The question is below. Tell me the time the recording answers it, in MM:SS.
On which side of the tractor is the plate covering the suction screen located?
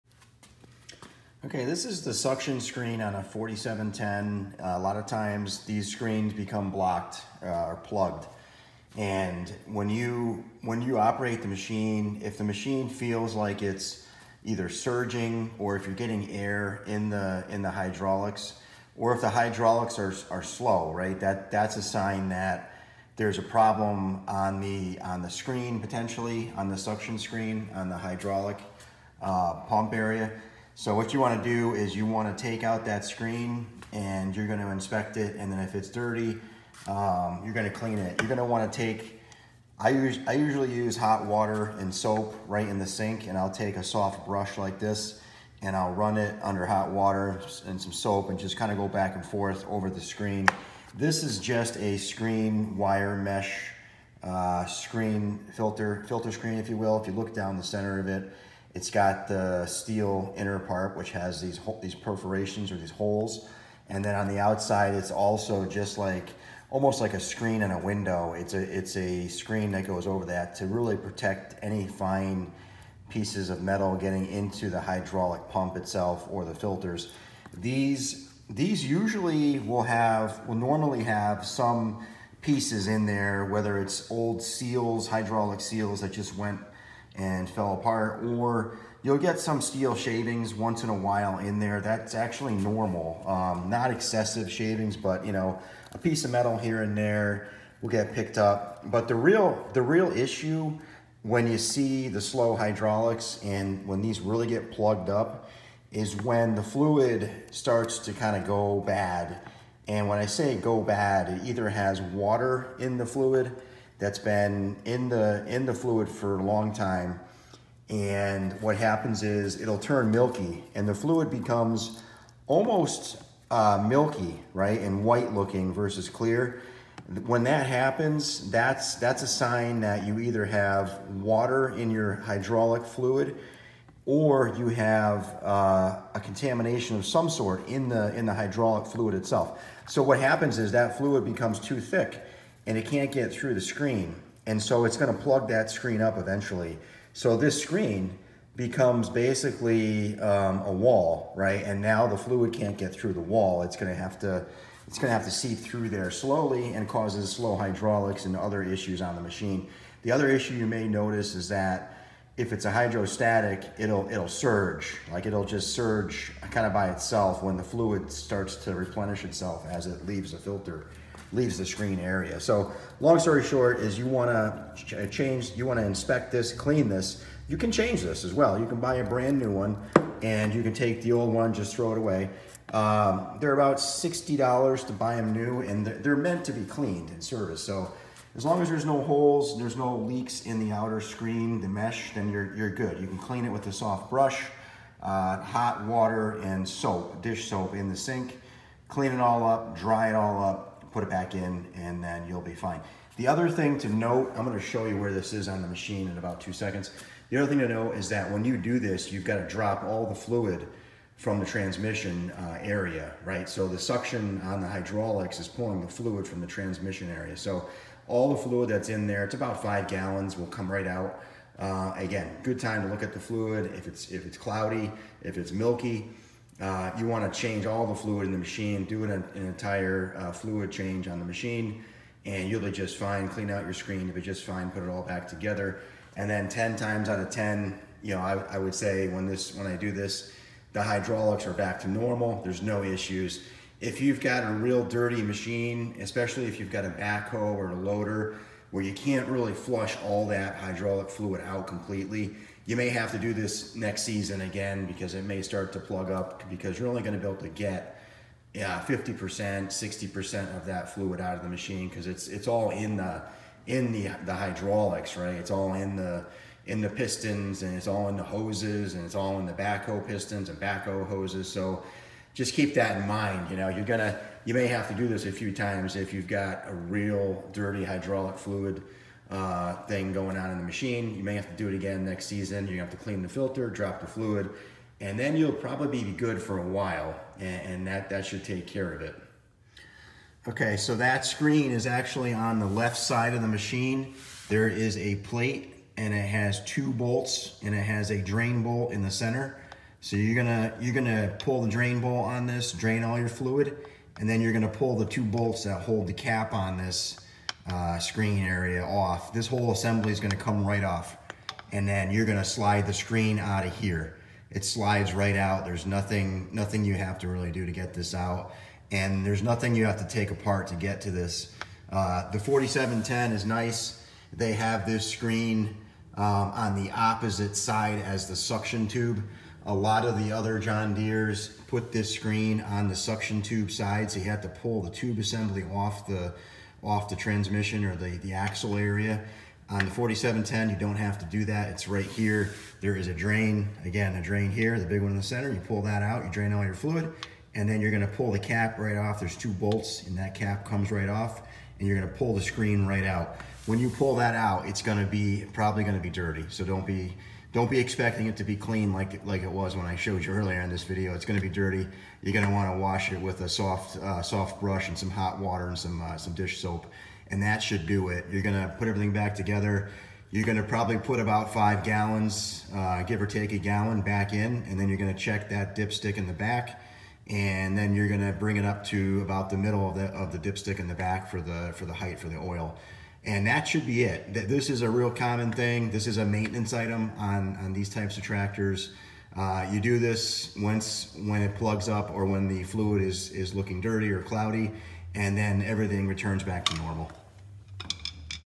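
04:52.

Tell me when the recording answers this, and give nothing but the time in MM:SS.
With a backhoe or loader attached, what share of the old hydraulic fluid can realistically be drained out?
04:18.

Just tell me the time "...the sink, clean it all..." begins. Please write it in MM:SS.
03:17.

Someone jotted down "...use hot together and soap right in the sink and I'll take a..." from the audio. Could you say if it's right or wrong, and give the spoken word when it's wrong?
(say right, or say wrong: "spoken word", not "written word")
wrong: "water", not "together".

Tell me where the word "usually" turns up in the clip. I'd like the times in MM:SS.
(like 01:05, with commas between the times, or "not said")
00:40, 01:18.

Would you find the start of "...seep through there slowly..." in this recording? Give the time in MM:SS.
02:35.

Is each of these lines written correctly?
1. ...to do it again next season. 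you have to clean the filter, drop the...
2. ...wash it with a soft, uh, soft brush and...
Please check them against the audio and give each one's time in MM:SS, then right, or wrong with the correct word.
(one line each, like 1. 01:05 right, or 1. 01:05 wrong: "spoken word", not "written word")
1. 04:41 right
2. 06:02 right.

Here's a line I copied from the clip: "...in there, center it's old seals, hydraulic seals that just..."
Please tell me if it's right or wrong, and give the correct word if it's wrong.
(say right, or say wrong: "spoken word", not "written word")
wrong: "whether", not "center".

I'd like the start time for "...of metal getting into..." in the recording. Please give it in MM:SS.
01:13.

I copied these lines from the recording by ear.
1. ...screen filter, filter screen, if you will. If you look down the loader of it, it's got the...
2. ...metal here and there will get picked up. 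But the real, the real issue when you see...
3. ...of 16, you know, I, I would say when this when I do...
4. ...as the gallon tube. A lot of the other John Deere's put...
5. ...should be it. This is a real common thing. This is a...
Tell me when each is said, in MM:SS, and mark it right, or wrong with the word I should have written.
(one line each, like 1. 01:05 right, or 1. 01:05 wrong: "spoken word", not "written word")
1. 00:54 wrong: "center", not "loader"
2. 01:36 right
3. 03:57 wrong: "10", not "16"
4. 05:28 wrong: "suction", not "gallon"
5. 06:23 right.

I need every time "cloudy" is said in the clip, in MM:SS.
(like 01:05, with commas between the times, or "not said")
03:44, 06:34.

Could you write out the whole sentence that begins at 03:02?
Um, they're about $60 to buy them new and they're, they're meant to be cleaned and serviced.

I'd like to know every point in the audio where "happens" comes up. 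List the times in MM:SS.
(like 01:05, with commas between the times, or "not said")
01:58, 02:07, 02:20.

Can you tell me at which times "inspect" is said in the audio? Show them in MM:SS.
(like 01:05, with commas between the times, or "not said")
00:34, 02:55.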